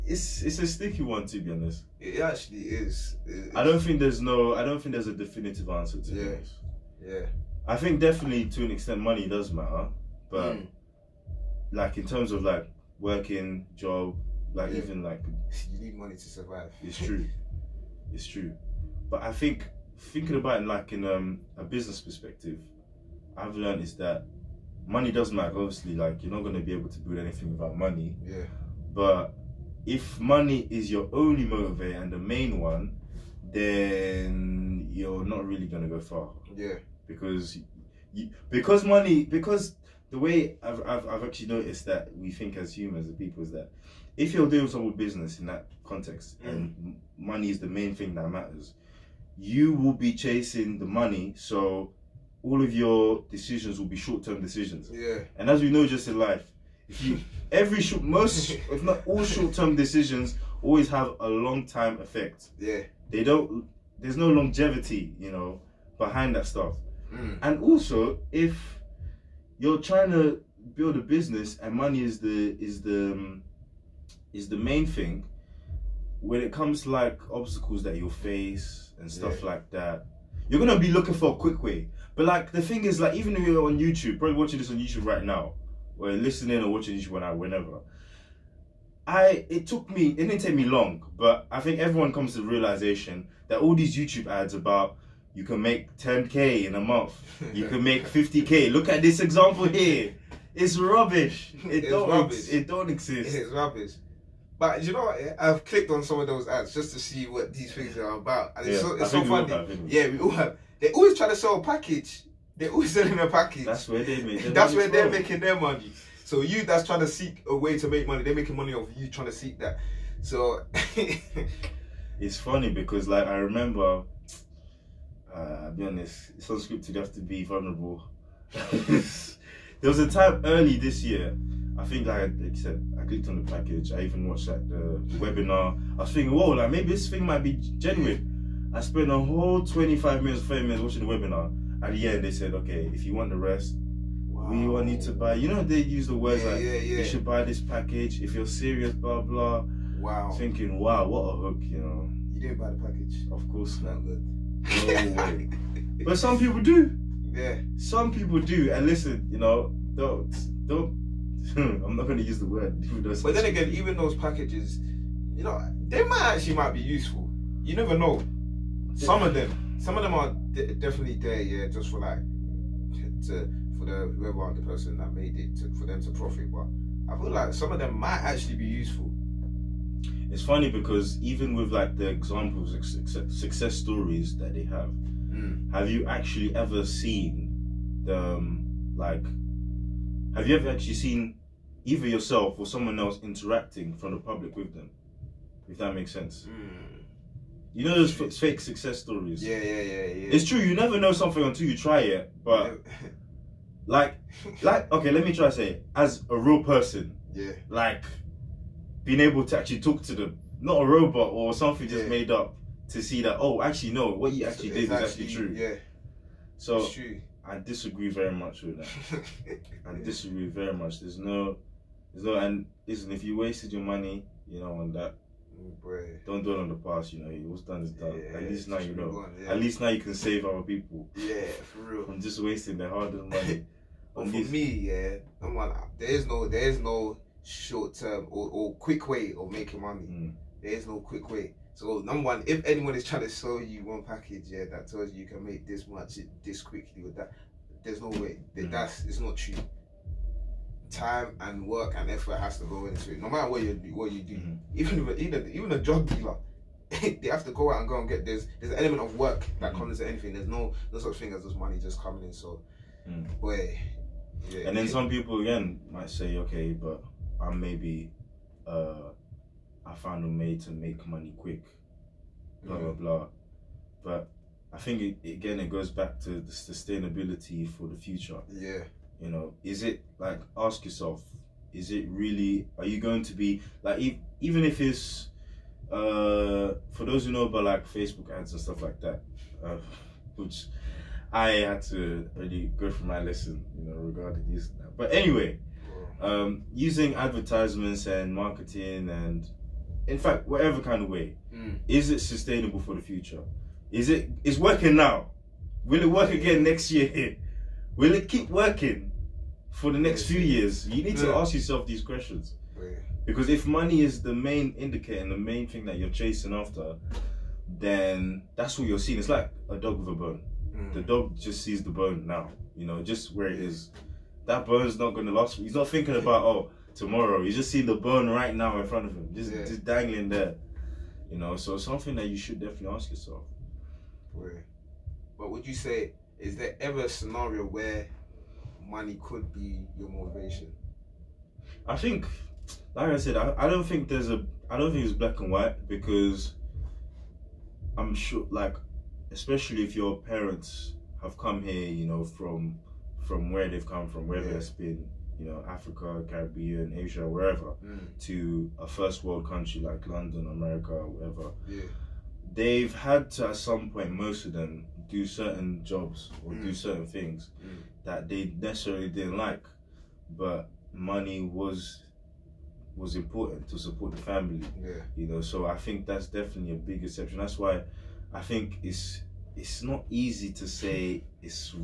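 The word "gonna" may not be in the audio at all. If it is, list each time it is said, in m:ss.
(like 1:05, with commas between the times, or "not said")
0:26, 0:35, 1:20.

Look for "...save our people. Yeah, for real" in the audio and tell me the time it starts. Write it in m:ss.
3:50.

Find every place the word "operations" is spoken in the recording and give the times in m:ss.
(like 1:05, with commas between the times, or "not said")
not said.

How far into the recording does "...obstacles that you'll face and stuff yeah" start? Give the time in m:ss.
1:17.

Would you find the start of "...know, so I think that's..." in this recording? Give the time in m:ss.
6:15.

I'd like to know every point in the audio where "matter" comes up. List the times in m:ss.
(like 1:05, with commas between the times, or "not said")
0:09, 0:25, 0:48, 4:13.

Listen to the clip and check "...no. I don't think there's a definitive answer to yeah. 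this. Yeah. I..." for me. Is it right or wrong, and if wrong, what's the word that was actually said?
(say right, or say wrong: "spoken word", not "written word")
right.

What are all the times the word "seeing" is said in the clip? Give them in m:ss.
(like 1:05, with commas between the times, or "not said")
5:18, 5:27.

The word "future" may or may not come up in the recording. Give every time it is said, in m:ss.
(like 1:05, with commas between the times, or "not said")
4:37, 5:03.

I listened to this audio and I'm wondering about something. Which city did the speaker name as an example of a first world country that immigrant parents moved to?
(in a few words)
London.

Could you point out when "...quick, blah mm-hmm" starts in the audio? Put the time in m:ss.
4:31.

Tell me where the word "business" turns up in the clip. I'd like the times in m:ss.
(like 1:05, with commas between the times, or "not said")
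0:21, 0:44, 1:10.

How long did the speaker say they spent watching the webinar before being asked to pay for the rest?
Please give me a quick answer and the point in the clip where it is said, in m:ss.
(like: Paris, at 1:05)
25 minutes, at 2:19.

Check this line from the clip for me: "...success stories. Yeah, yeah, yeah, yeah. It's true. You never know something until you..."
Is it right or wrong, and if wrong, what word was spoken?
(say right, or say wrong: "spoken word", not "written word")
right.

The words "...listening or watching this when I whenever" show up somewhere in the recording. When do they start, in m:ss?
1:26.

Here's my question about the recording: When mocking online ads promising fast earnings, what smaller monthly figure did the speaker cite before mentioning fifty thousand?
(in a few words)
10k.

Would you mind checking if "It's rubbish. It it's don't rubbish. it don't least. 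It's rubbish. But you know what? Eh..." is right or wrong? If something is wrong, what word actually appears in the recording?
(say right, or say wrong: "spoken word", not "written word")
wrong: "exist", not "least".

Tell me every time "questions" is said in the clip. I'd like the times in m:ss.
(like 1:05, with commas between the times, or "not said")
5:12.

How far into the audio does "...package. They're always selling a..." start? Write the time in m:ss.
1:51.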